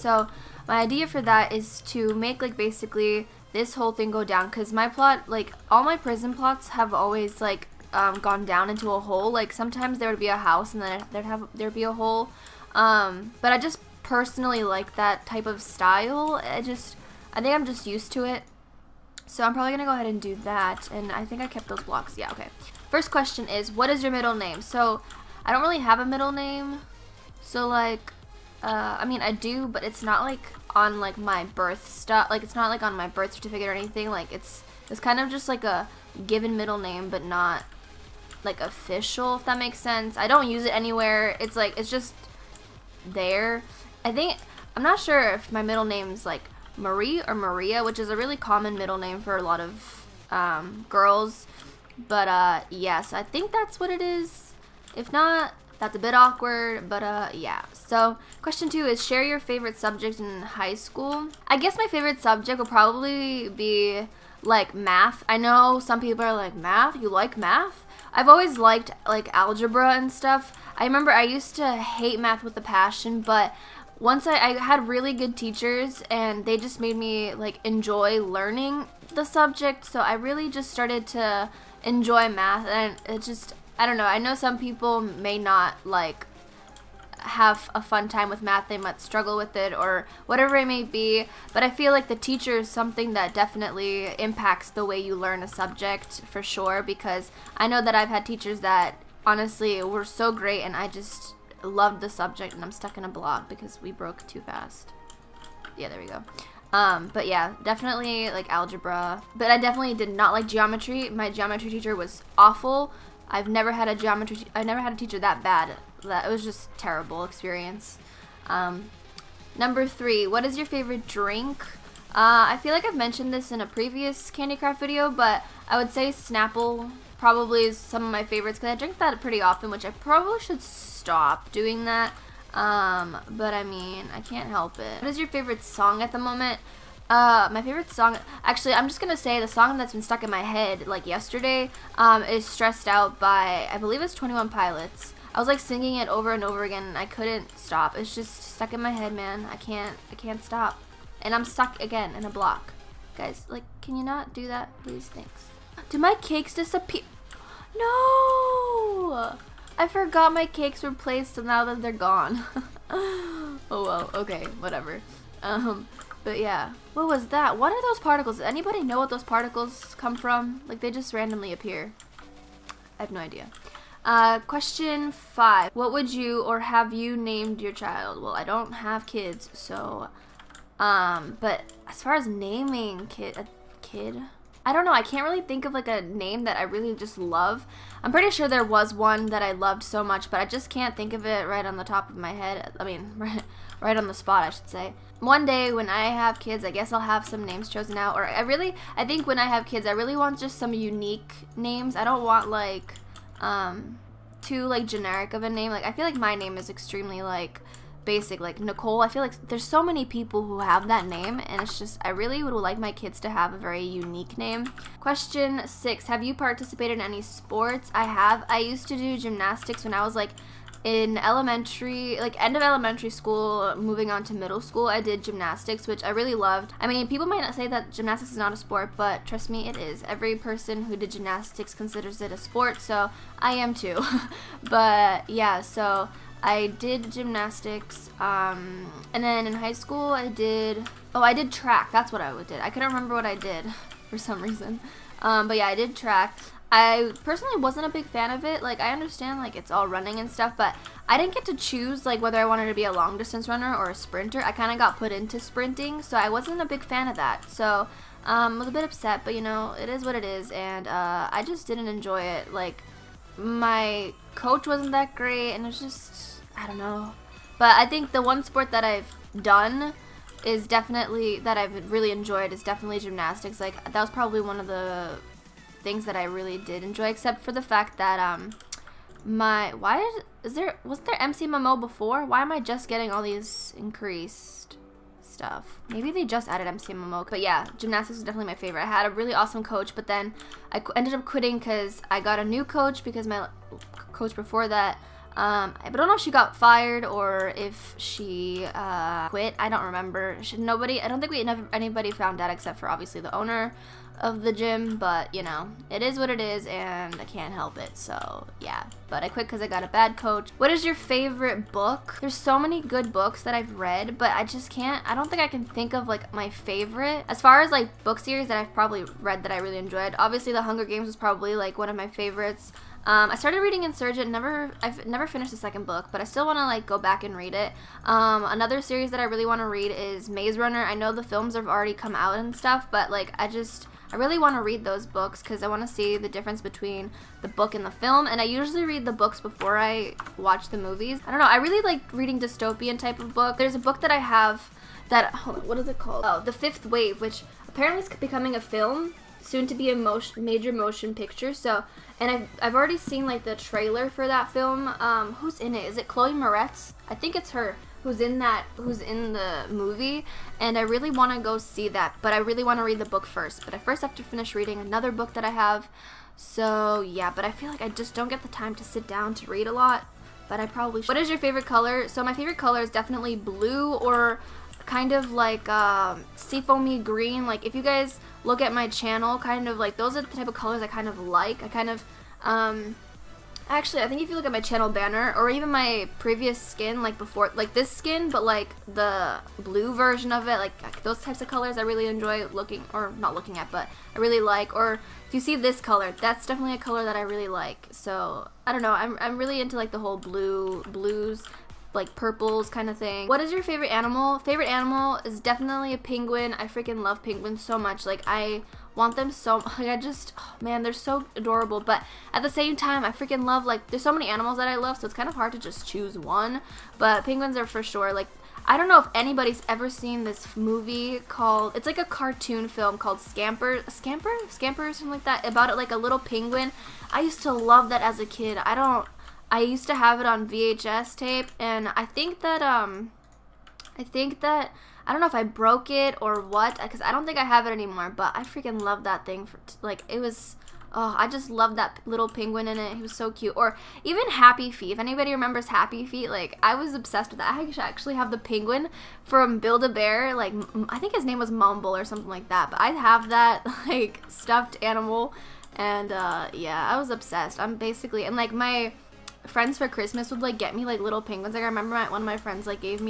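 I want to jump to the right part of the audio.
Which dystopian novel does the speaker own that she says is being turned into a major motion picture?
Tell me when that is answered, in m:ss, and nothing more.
5:46.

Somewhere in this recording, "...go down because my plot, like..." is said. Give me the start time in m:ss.
0:04.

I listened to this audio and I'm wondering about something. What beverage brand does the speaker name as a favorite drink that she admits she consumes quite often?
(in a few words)
Snapple.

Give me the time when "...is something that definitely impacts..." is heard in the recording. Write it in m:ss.
1:32.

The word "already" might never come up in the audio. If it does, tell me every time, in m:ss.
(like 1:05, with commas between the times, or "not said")
5:31, 5:52.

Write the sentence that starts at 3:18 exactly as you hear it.
Or I really, I think when I have kids, I really want just some unique names.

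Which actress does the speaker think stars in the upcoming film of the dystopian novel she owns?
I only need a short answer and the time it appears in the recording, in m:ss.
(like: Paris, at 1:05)
Chloe Moretz, at 5:56.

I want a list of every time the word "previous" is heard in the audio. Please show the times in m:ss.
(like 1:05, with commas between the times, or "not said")
2:03, 6:26.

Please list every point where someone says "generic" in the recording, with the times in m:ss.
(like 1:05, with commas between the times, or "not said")
3:24.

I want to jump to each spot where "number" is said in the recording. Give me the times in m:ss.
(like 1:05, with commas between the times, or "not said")
1:59.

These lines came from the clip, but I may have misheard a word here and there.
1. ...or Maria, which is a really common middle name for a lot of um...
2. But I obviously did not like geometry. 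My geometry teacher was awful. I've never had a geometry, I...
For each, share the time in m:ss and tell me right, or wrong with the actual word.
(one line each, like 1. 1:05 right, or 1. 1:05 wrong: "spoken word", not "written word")
1. 0:47 right
2. 1:49 wrong: "definitely", not "obviously".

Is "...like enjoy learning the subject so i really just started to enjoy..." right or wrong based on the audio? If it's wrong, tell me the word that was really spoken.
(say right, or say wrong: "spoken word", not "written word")
right.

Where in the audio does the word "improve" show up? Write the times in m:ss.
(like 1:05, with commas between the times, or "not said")
not said.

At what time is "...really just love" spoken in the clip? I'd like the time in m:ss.
3:06.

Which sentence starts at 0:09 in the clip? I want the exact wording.
Like sometimes there would be a house and then there'd have there'd be a hole.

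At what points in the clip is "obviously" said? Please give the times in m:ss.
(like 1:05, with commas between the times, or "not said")
5:02, 5:20.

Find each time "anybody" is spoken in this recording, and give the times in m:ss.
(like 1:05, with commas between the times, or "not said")
2:48, 5:01, 6:59, 7:24.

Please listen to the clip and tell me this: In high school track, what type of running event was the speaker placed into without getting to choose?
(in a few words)
Sprinting.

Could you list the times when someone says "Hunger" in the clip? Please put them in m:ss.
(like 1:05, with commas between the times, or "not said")
5:20.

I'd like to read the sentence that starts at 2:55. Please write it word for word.
What would you or have you named your child?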